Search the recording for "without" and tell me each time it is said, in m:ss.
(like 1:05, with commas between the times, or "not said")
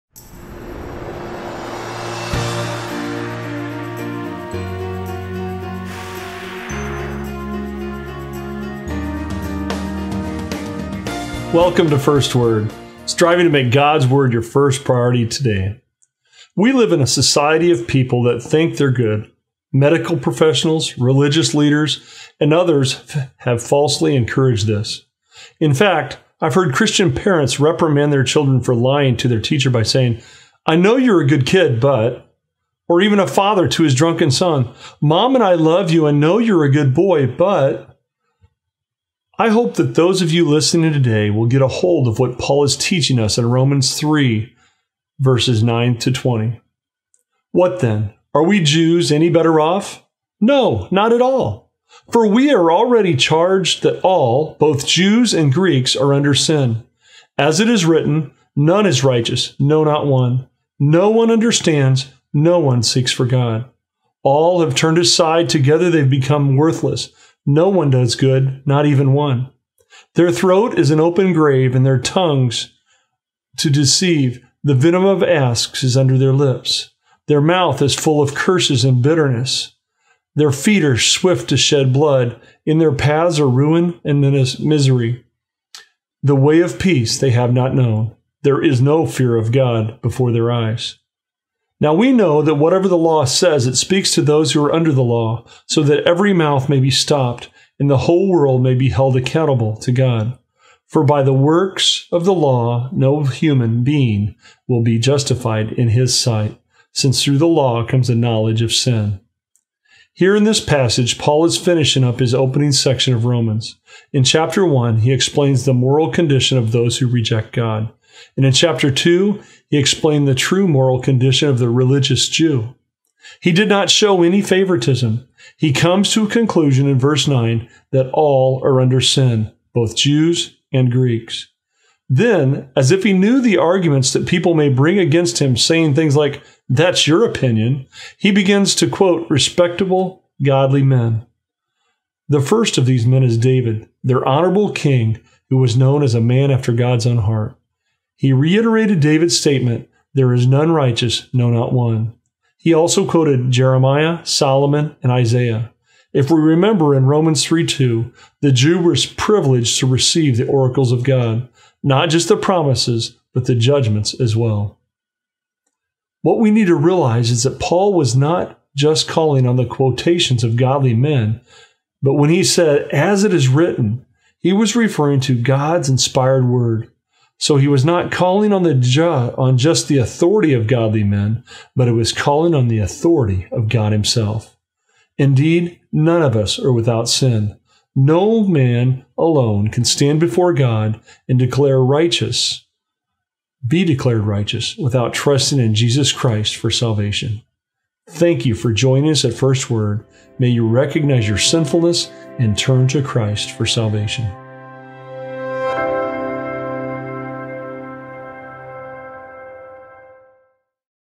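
3:06, 3:14.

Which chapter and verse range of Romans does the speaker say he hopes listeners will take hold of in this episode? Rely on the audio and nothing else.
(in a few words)
Romans 3, verses 9 to 20.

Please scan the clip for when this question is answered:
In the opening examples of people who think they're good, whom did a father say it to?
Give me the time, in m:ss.
0:33.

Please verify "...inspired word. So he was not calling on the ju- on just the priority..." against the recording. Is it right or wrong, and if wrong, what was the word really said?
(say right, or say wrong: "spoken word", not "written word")
wrong: "authority", not "priority".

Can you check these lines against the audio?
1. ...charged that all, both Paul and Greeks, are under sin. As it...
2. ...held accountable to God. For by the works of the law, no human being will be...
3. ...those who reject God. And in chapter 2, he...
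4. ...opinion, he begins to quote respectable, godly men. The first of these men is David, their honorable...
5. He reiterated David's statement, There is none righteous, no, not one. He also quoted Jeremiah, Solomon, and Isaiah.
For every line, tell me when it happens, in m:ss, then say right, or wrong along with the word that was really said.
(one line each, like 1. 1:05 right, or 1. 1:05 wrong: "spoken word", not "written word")
1. 0:53 wrong: "Jews", not "Paul"
2. 1:38 right
3. 1:56 right
4. 2:17 right
5. 2:28 right.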